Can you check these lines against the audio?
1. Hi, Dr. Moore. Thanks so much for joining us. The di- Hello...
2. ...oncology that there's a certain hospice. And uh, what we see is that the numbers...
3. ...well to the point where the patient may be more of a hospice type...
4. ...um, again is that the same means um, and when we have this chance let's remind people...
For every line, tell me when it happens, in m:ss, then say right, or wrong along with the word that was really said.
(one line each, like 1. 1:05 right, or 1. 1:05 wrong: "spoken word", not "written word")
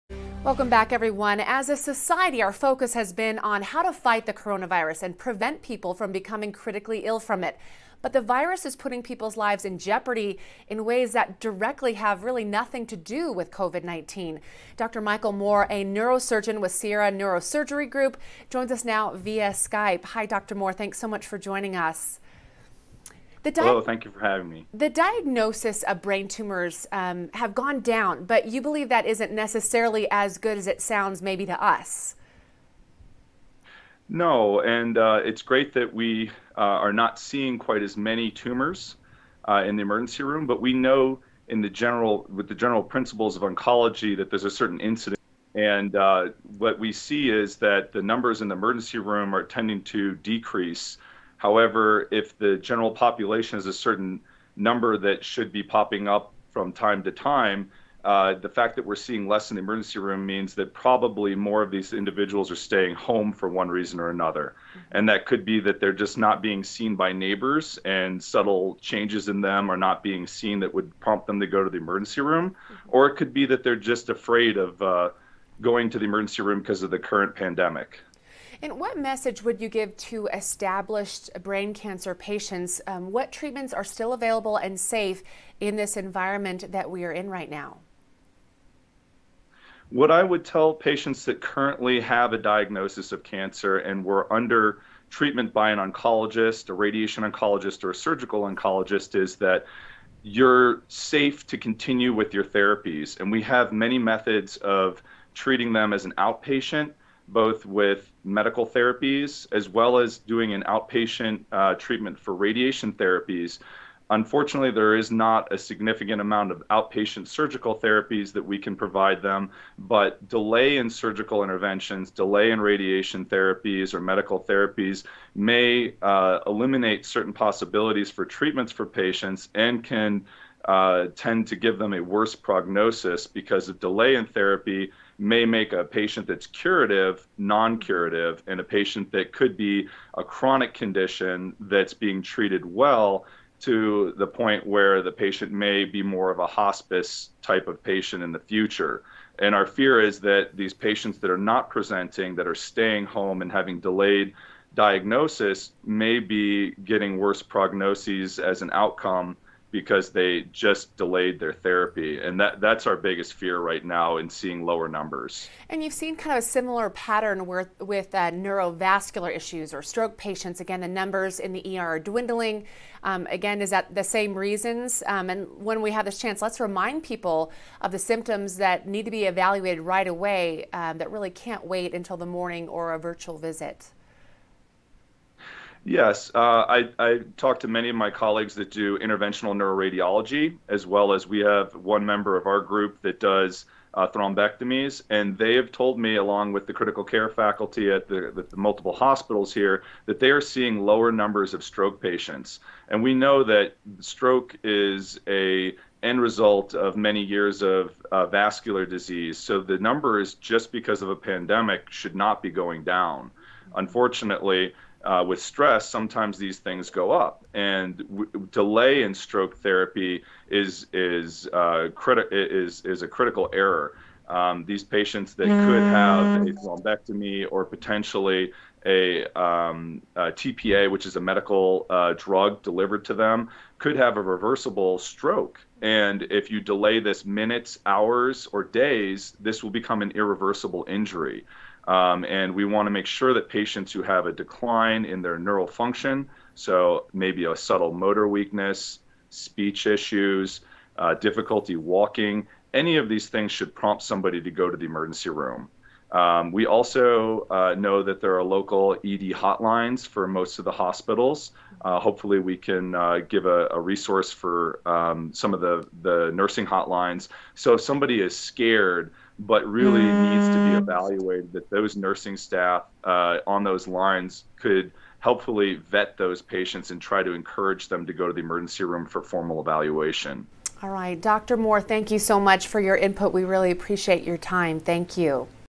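1. 0:20 right
2. 0:43 wrong: "incidence", not "hospice"
3. 2:22 right
4. 2:53 wrong: "reasons", not "means".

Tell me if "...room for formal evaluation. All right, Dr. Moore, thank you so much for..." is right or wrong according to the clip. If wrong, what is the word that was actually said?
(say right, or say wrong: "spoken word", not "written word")
right.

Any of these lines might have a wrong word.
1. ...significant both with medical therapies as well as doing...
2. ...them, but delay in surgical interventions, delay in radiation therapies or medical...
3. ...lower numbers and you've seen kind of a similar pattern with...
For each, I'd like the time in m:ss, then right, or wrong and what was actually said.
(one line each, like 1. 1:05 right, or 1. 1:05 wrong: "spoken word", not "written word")
1. 1:46 wrong: "outpatient", not "significant"
2. 1:59 right
3. 2:44 right.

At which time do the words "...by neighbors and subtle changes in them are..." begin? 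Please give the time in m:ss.
1:06.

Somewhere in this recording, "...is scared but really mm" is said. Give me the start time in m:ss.
4:28.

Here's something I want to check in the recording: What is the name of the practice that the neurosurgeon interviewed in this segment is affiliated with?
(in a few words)
Sierra Neurosurgery Group.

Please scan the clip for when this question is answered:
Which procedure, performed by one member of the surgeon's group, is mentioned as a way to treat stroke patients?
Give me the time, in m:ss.
3:14.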